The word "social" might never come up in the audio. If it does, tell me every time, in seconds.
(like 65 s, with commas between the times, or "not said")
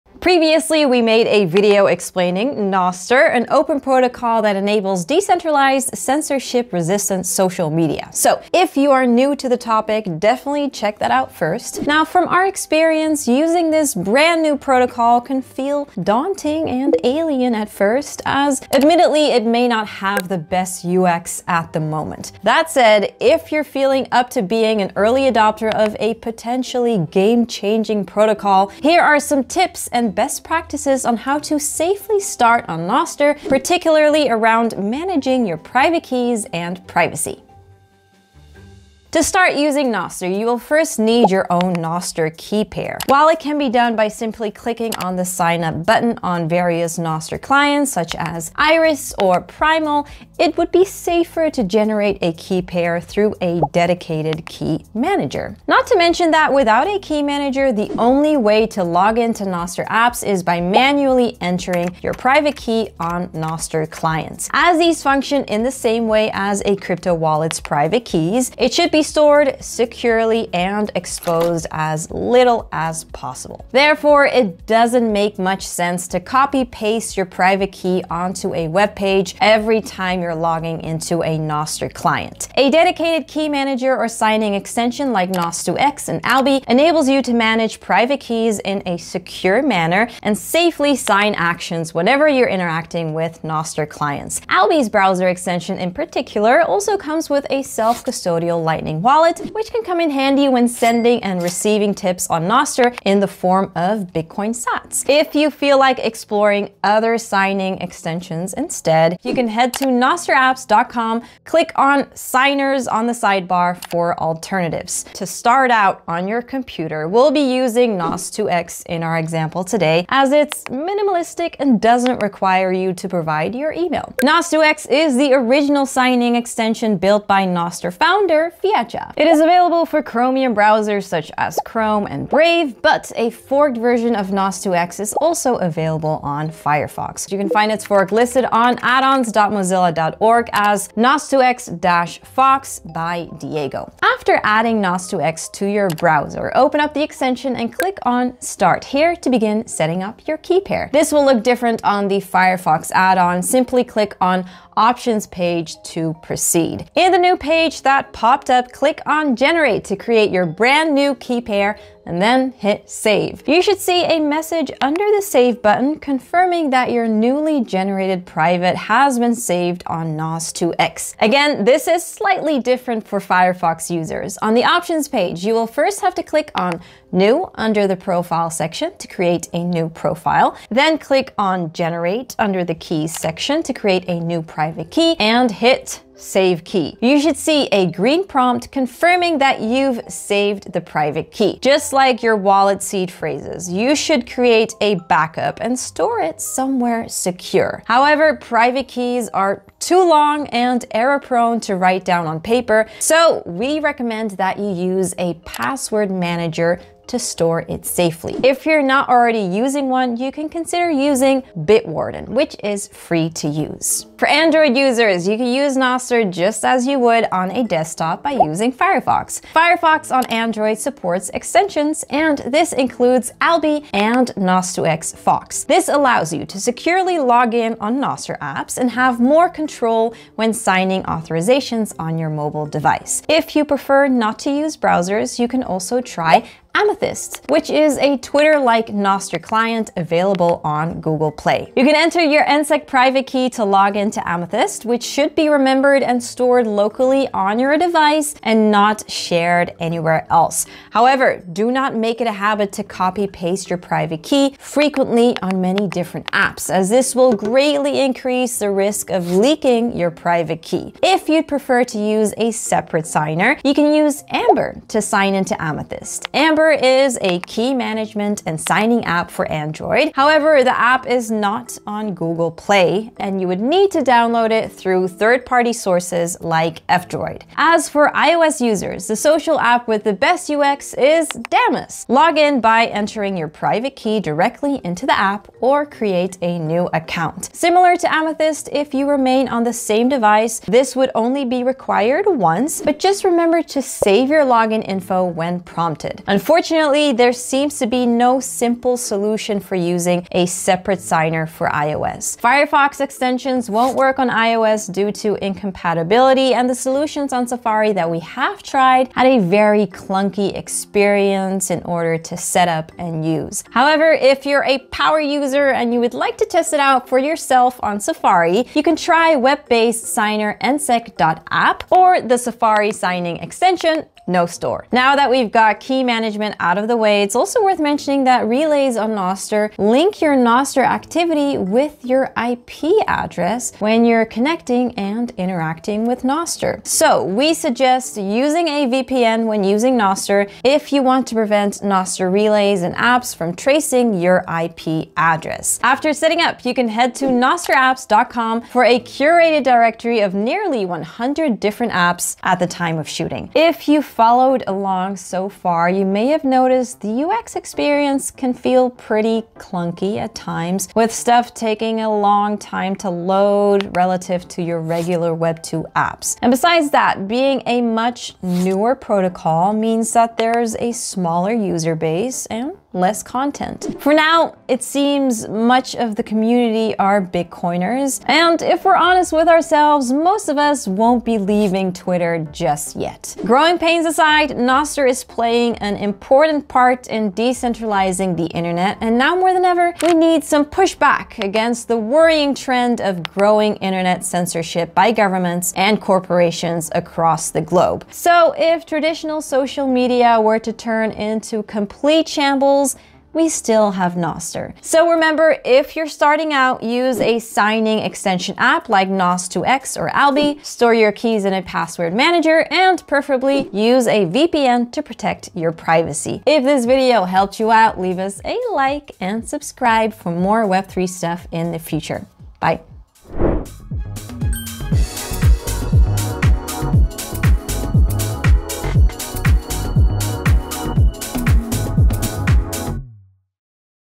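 7 s, 279 s, 399 s.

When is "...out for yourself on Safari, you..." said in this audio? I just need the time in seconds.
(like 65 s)
316 s.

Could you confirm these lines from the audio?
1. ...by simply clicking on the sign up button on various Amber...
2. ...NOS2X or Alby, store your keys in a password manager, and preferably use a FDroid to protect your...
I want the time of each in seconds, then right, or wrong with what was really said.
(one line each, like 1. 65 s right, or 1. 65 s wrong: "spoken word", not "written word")
1. 43 s wrong: "Nostr", not "Amber"
2. 409 s wrong: "VPN", not "FDroid".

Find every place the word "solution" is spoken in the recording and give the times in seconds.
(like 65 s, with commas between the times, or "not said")
298 s, 306 s.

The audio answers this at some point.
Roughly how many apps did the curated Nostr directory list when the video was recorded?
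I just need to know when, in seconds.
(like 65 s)
350 s.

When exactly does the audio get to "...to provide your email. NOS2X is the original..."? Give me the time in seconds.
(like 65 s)
122 s.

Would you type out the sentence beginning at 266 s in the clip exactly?
Amber Cucumber is a key management and signing app for Android.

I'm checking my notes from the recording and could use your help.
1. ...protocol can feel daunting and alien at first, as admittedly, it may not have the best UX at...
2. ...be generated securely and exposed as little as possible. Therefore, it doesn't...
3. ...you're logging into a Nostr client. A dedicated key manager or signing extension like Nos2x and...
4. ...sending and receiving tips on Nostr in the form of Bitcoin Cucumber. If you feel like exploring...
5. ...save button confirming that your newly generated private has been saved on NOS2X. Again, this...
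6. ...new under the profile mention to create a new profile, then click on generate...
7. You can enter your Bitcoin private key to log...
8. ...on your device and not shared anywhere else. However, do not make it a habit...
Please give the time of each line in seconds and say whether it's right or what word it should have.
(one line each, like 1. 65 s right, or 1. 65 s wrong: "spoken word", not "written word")
1. 14 s right
2. 68 s wrong: "stored", not "generated"
3. 80 s right
4. 100 s wrong: "Sats", not "Cucumber"
5. 165 s right
6. 177 s wrong: "section", not "mention"
7. 241 s wrong: "NSEC", not "Bitcoin"
8. 247 s right.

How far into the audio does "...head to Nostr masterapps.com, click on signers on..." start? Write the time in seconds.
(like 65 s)
109 s.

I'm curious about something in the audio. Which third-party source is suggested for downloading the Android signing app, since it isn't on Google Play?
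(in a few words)
F-Droid.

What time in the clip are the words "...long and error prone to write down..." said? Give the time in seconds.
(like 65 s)
200 s.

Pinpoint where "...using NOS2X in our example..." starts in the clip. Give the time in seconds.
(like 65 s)
117 s.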